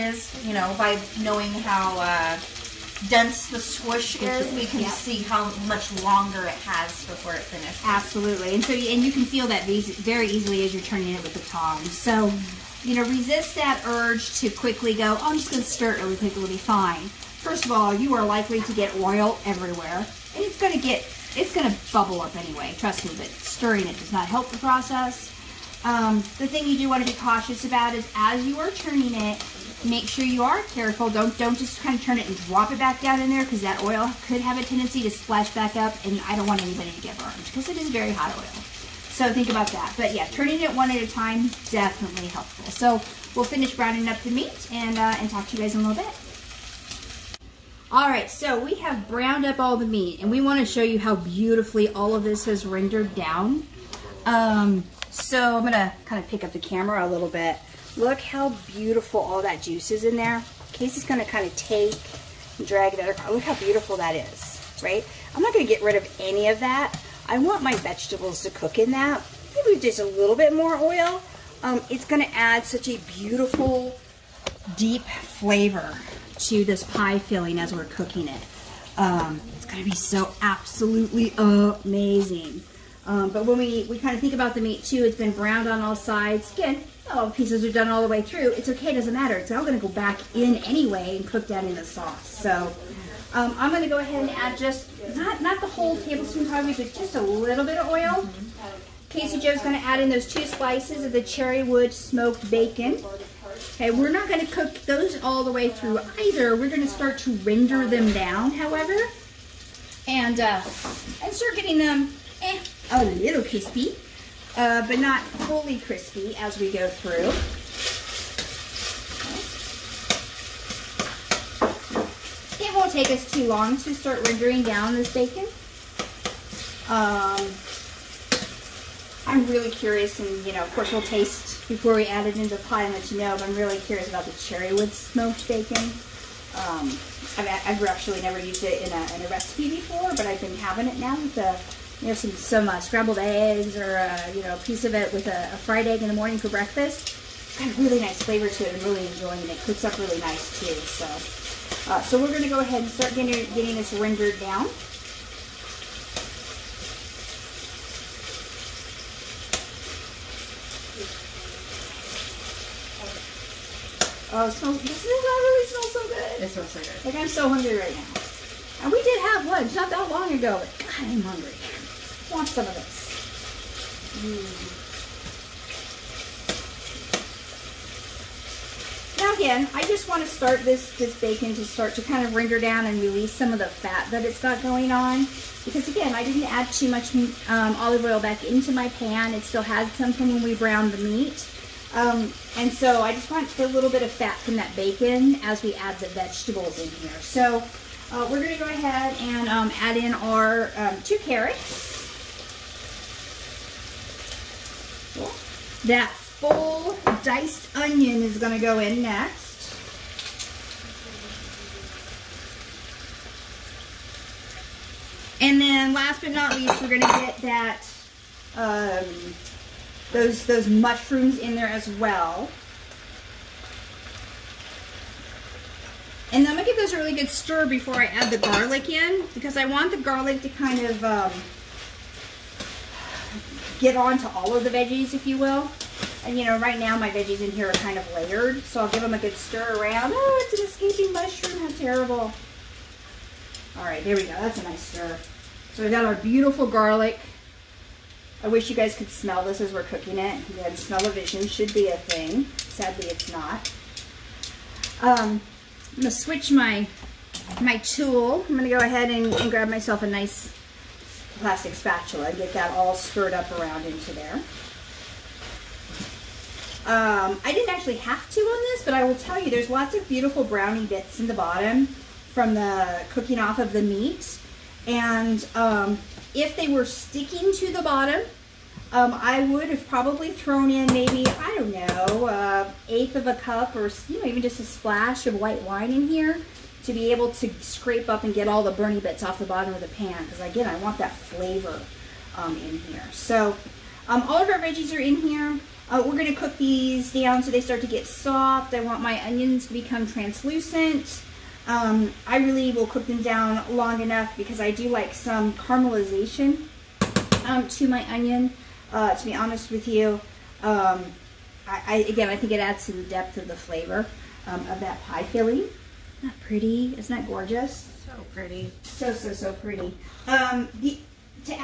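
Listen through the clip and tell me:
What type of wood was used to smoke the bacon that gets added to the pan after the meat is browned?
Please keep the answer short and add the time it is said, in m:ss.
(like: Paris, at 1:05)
cherry wood, at 1:41.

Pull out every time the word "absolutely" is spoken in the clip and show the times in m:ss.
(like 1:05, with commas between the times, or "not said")
0:07, 1:20.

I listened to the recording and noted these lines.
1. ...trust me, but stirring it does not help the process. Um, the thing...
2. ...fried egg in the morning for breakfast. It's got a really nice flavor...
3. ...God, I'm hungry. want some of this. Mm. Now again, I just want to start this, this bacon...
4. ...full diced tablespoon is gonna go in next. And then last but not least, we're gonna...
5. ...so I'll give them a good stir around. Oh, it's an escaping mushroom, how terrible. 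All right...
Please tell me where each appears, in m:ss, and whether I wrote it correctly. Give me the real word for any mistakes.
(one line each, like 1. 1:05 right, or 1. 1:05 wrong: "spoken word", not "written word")
1. 0:22 right
2. 2:25 right
3. 2:50 right
4. 3:26 wrong: "onion", not "tablespoon"
5. 3:58 right.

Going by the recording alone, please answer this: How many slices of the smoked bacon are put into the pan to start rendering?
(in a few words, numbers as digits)
2.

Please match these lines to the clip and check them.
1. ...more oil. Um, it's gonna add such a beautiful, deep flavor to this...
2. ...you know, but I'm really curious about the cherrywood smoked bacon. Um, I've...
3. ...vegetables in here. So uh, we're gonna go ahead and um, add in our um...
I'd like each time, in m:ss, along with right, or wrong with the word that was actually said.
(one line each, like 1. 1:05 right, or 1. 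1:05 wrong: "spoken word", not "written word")
1. 1:10 right
2. 2:13 right
3. 3:16 right.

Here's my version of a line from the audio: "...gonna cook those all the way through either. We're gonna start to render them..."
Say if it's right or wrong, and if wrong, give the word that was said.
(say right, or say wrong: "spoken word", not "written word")
right.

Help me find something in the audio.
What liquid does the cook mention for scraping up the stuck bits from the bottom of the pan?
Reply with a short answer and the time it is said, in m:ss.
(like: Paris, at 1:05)
white wine, at 4:45.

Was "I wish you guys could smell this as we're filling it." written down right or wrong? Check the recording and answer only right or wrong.
wrong.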